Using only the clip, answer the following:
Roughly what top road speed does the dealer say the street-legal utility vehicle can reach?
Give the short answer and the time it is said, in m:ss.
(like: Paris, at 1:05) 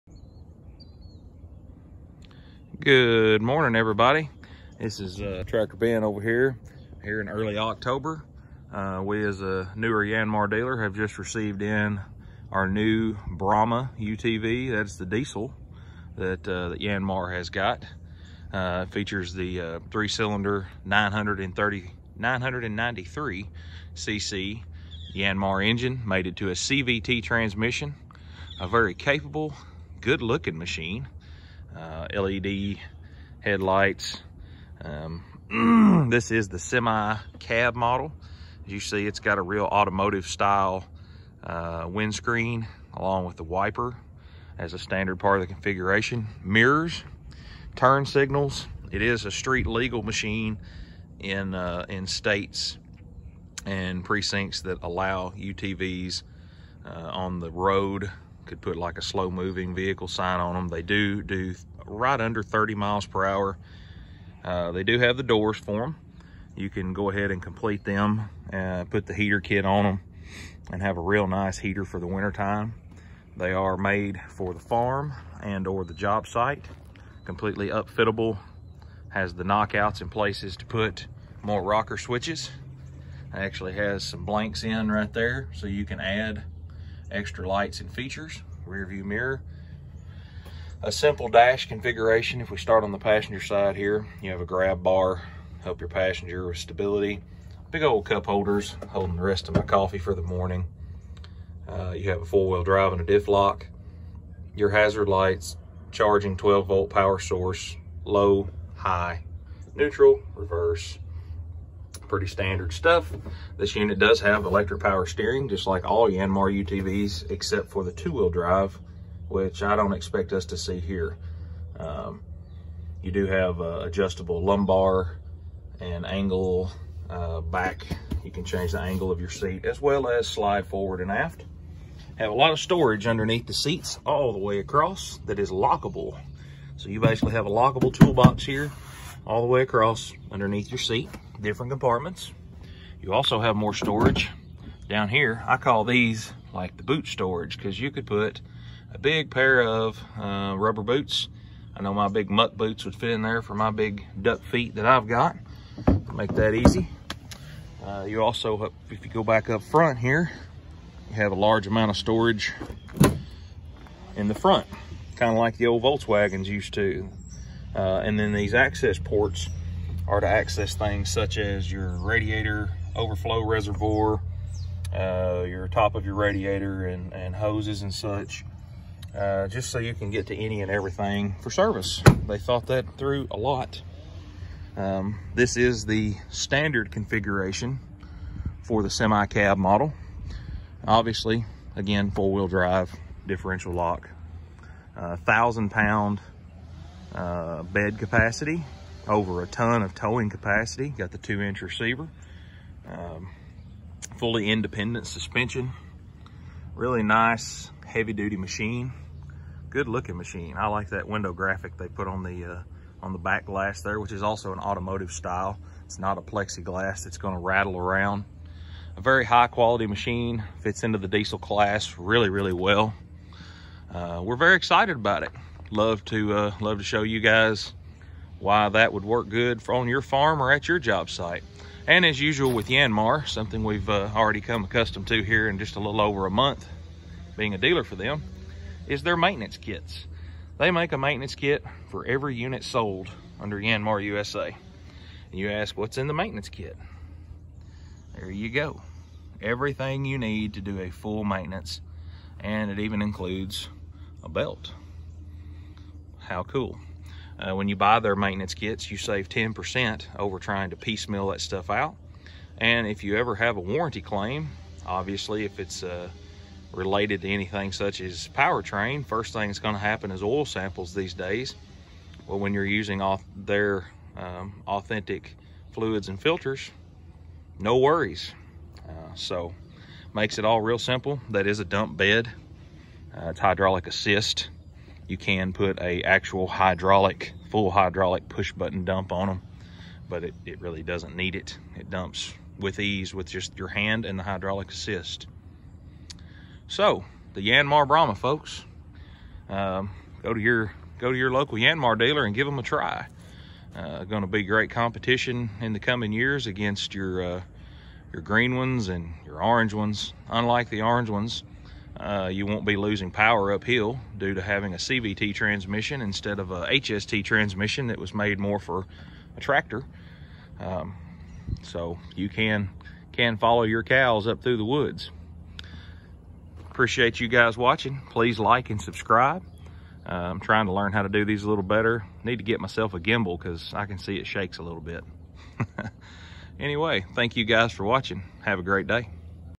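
30 mph, at 1:02.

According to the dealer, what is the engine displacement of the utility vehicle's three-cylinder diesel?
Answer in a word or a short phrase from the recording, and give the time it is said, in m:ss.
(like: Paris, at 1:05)
993 cc, at 0:22.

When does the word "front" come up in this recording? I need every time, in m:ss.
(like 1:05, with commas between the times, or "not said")
2:39, 2:44.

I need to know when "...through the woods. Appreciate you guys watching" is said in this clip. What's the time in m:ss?
5:24.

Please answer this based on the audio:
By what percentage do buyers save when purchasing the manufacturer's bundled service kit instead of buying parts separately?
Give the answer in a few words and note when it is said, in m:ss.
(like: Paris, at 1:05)
10%, at 4:19.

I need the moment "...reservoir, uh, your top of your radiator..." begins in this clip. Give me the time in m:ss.
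2:53.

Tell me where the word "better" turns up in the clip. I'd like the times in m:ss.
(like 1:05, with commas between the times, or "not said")
5:31.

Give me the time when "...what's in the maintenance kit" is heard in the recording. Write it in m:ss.
4:05.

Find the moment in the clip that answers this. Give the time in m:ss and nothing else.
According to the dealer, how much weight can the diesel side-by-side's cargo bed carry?
3:15.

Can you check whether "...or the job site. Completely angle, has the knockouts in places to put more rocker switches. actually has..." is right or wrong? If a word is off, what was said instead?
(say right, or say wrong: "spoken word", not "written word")
wrong: "upfittable", not "angle".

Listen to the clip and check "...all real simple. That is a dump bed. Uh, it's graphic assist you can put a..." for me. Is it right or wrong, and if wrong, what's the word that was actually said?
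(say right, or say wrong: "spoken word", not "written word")
wrong: "hydraulic", not "graphic".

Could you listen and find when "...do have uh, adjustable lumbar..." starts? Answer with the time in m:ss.
2:03.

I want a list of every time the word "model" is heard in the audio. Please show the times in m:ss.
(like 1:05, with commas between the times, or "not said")
0:37, 3:09.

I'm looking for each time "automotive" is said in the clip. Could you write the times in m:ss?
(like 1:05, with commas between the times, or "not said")
0:39, 3:34.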